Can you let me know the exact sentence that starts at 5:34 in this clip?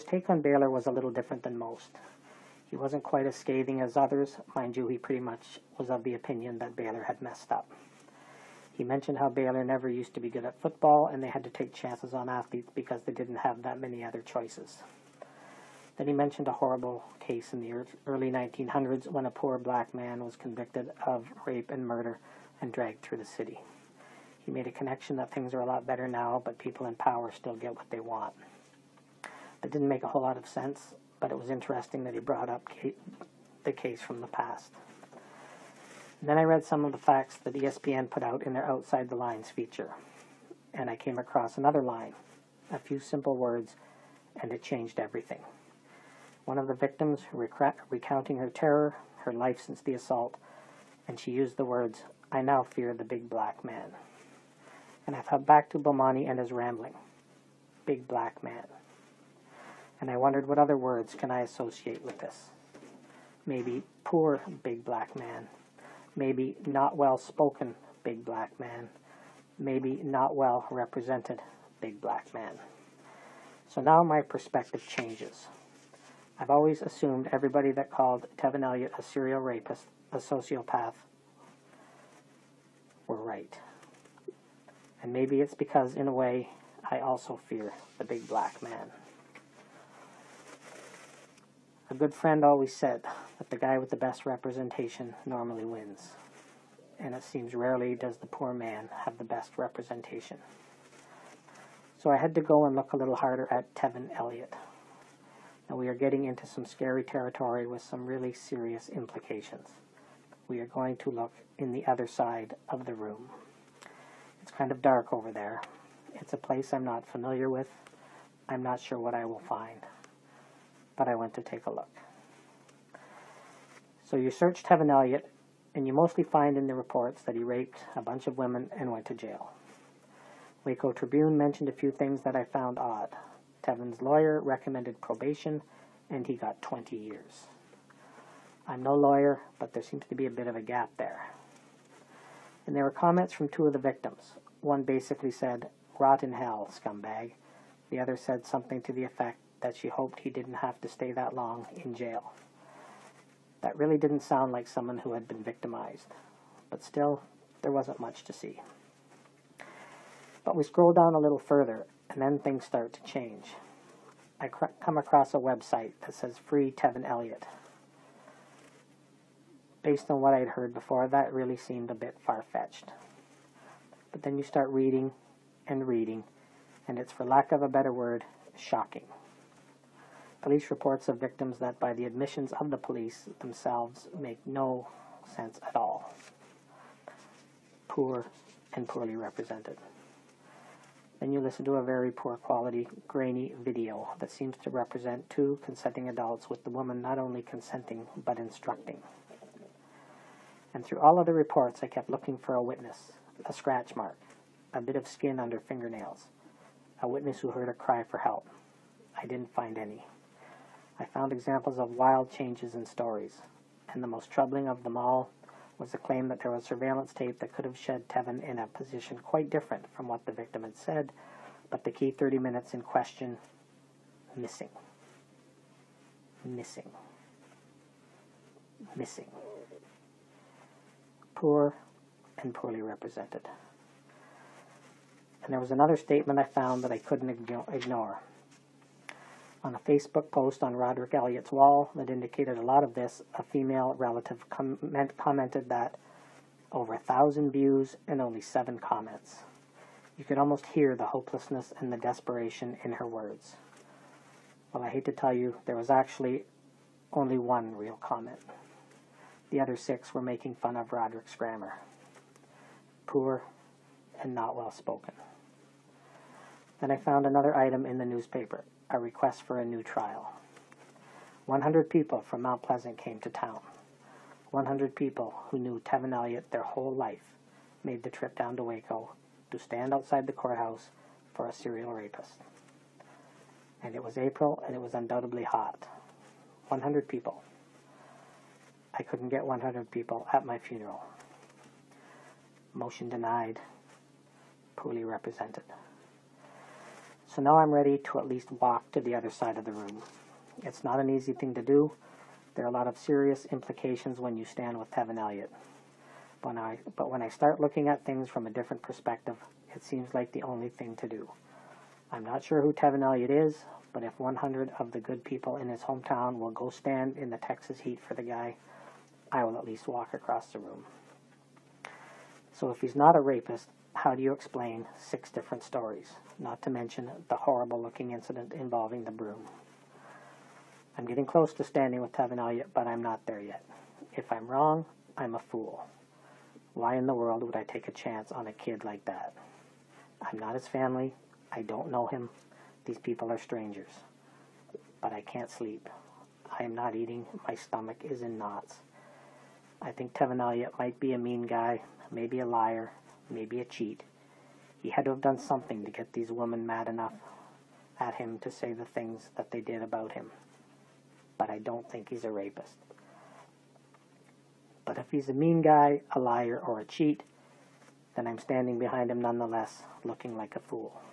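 If I'm wrong, I'm a fool.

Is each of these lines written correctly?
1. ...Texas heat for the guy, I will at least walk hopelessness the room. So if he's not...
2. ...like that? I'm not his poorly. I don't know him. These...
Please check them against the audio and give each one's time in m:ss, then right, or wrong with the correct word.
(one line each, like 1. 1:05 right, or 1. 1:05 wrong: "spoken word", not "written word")
1. 5:17 wrong: "across", not "hopelessness"
2. 5:38 wrong: "family", not "poorly".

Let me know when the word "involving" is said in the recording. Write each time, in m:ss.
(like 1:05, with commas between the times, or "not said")
5:28.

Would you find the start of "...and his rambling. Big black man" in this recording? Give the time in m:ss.
0:56.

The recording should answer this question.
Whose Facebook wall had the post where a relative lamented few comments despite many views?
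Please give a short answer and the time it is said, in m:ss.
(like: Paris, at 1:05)
Rodrick Elliott, at 4:00.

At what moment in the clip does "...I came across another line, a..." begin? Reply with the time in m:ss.
0:40.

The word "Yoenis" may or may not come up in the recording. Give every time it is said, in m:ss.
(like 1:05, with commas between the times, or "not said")
not said.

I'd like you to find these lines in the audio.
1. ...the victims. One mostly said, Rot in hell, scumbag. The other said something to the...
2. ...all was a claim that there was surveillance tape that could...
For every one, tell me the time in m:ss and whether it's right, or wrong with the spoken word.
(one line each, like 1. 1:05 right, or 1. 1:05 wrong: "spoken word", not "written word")
1. 2:23 wrong: "basically", not "mostly"
2. 3:34 right.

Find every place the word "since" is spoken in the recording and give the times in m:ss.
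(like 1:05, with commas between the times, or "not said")
0:49.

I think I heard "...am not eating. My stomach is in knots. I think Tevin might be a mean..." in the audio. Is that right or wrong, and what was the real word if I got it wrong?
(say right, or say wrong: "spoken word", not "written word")
right.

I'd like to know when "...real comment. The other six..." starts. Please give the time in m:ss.
4:17.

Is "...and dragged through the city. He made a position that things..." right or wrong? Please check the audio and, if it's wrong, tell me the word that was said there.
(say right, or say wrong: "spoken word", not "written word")
wrong: "connection", not "position".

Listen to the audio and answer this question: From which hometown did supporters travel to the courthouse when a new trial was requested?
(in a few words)
Mount Pleasant.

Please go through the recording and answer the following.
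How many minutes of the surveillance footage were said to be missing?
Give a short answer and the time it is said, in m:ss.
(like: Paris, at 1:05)
30, at 3:42.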